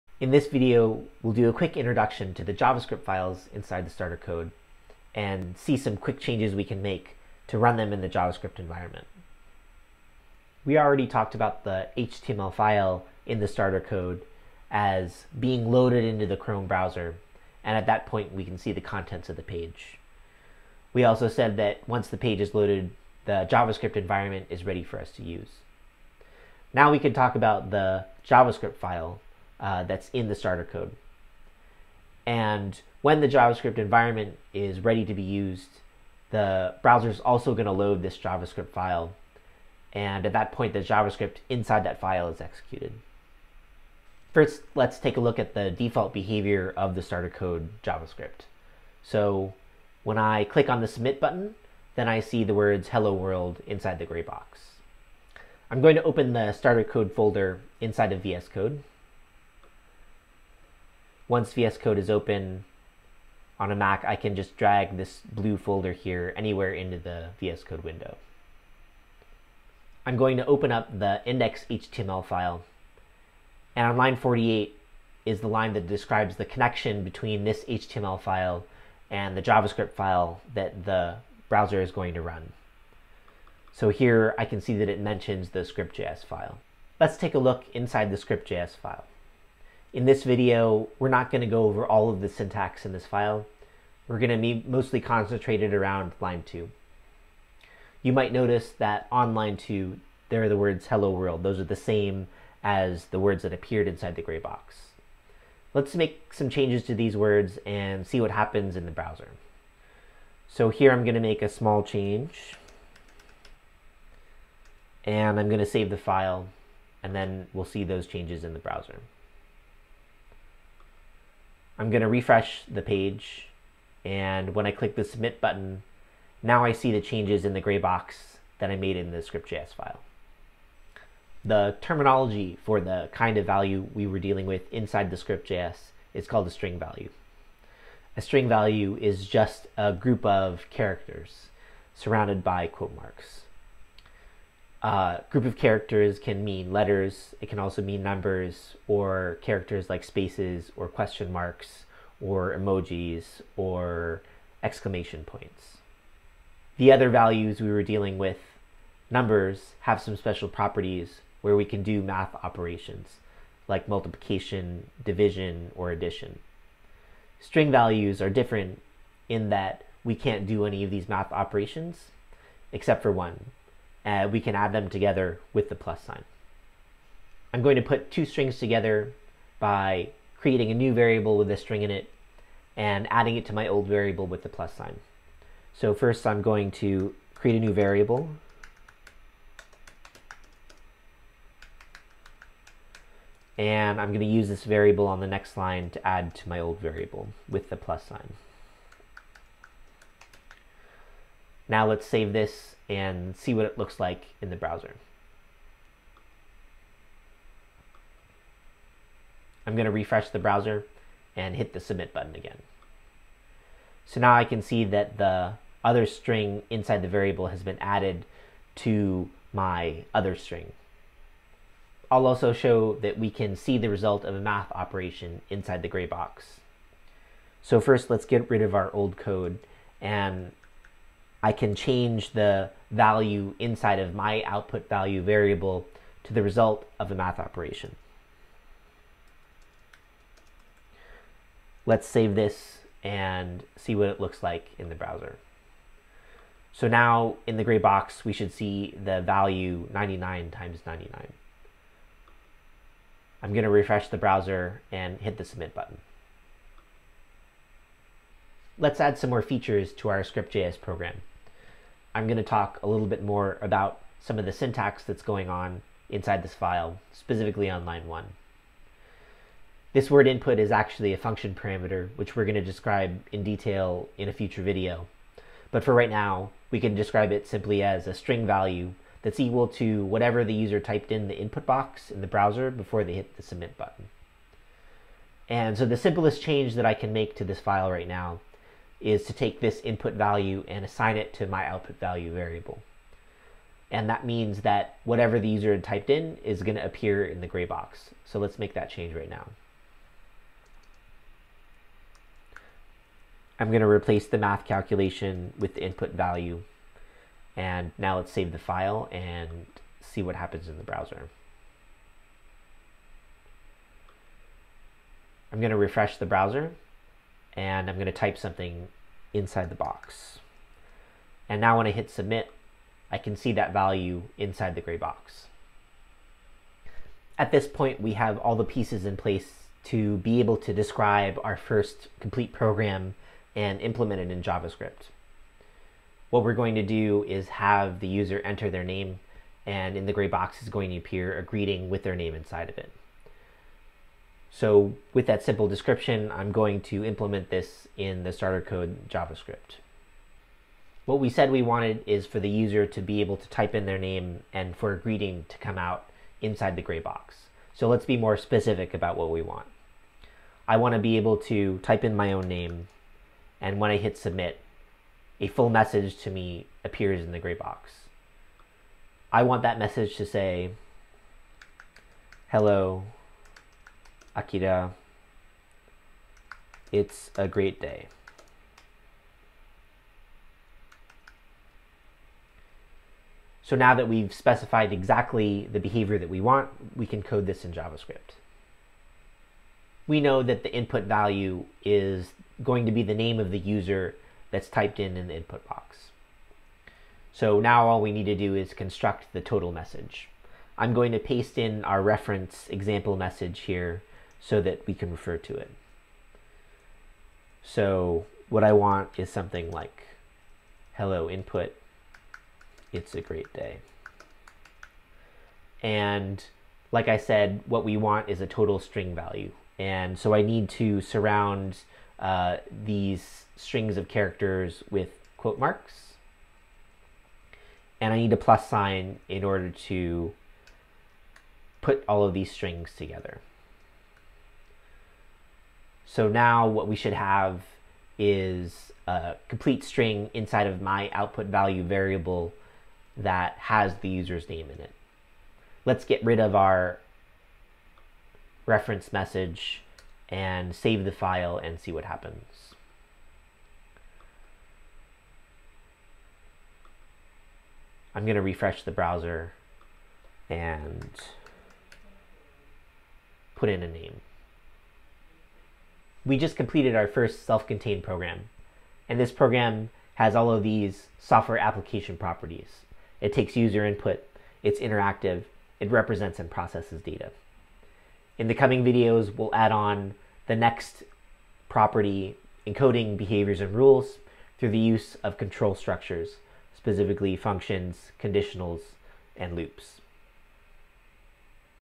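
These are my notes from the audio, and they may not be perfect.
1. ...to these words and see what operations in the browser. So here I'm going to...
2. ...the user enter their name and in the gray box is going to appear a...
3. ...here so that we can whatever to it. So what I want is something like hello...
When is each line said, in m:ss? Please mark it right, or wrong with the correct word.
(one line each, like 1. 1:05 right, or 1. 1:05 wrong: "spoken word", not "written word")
1. 1:46 wrong: "happens", not "operations"
2. 5:37 right
3. 6:43 wrong: "refer", not "whatever".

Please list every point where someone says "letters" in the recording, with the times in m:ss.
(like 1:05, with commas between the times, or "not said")
2:26.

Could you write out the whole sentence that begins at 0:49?
So when I click on the submit button, then I see the words hello world inside the gray box.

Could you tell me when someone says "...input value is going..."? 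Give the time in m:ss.
6:30.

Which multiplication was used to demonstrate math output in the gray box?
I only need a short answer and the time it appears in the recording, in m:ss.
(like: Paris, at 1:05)
99 times 99, at 4:09.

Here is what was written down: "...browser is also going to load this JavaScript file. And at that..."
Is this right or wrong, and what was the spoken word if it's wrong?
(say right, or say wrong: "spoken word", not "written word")
right.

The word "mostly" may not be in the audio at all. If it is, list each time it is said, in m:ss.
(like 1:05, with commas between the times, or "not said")
1:34.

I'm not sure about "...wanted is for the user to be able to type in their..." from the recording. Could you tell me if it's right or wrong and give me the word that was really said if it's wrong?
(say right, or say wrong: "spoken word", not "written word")
right.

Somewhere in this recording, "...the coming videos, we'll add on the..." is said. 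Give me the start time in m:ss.
7:58.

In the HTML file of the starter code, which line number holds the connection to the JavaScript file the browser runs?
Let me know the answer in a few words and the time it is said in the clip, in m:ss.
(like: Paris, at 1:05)
48, at 1:13.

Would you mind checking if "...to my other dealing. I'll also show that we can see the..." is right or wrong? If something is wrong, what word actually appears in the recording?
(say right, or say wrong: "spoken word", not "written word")
wrong: "string", not "dealing".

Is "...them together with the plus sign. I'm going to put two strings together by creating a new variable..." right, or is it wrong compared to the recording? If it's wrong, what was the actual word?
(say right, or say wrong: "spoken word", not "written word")
right.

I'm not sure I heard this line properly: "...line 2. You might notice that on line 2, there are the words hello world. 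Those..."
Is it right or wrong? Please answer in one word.
right.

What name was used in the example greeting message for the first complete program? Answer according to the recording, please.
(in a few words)
Akira.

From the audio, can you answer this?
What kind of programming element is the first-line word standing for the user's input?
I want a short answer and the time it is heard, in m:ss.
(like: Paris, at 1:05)
function parameter, at 4:31.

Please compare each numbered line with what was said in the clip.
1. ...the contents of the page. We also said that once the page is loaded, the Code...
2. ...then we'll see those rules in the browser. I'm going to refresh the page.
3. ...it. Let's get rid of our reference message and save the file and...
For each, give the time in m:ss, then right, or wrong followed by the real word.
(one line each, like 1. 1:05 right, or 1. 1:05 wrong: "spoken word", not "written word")
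1. 0:18 wrong: "JavaScript", not "Code"
2. 1:57 wrong: "changes", not "rules"
3. 7:24 right.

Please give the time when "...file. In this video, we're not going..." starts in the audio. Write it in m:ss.
1:28.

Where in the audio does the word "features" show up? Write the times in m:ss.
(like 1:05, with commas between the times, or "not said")
4:19.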